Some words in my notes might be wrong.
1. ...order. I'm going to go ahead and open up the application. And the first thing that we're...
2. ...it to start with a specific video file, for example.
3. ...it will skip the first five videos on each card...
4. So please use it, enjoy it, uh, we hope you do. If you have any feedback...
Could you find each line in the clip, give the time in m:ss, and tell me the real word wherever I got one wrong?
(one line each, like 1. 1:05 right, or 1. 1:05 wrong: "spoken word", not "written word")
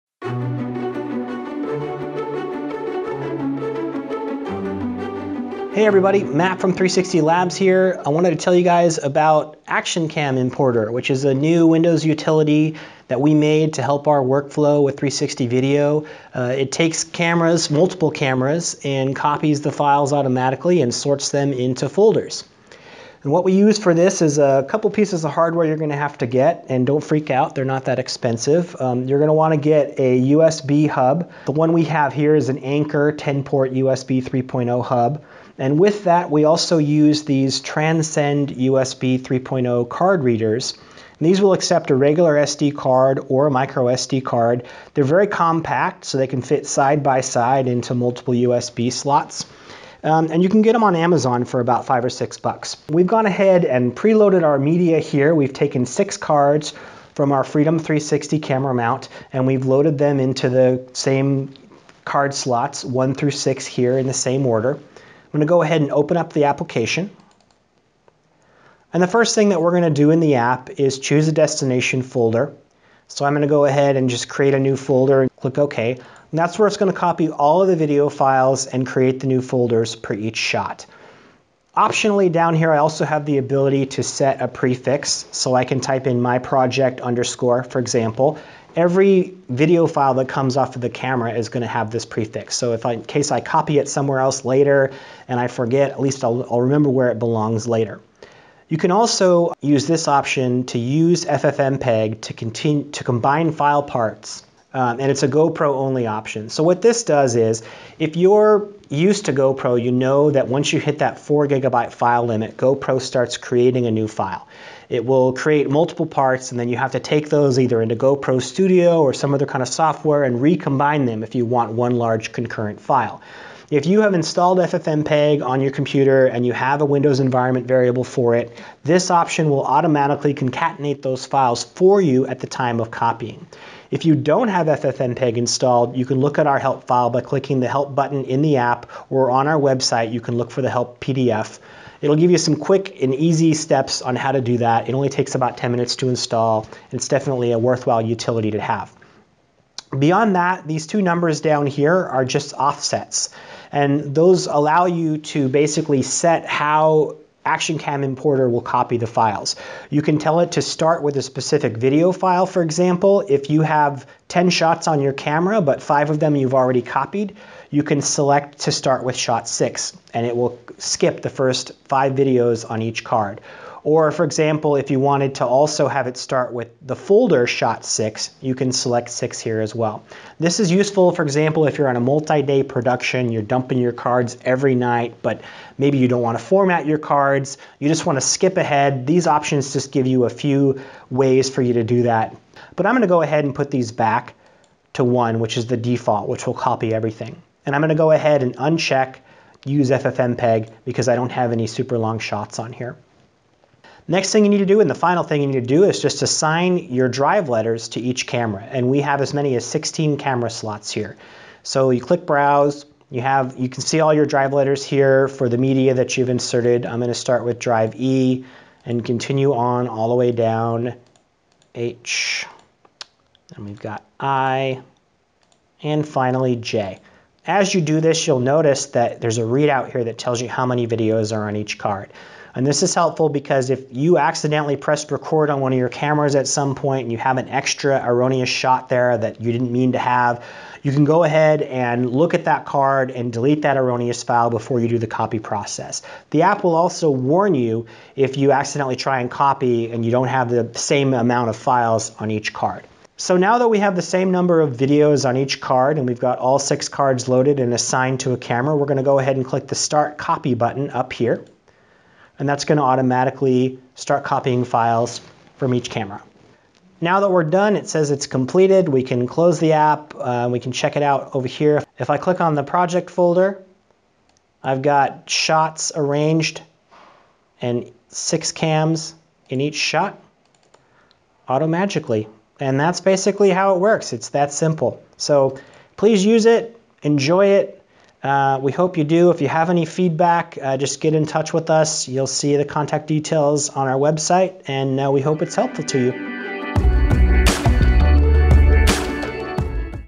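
1. 1:04 right
2. 2:40 right
3. 2:50 right
4. 4:45 right.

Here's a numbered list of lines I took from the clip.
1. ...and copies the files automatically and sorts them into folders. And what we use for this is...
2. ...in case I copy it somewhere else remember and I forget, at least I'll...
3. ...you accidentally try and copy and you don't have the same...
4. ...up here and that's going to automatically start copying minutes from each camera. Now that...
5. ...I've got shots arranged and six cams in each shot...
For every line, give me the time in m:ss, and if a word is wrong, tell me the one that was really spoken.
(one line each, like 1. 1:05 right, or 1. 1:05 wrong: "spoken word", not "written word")
1. 0:18 right
2. 1:32 wrong: "later", not "remember"
3. 4:08 right
4. 4:20 wrong: "files", not "minutes"
5. 4:34 right.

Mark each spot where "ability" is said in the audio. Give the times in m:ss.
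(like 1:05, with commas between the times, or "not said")
1:23.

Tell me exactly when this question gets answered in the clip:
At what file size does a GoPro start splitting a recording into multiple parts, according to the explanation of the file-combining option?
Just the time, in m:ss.
1:51.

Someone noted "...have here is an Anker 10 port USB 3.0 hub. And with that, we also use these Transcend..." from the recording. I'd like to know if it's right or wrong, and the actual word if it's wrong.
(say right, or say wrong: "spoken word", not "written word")
right.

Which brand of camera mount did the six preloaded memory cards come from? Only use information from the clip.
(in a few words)
Freedom 360.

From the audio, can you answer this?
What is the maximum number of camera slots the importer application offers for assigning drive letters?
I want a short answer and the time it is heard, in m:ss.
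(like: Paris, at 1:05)
16, at 3:29.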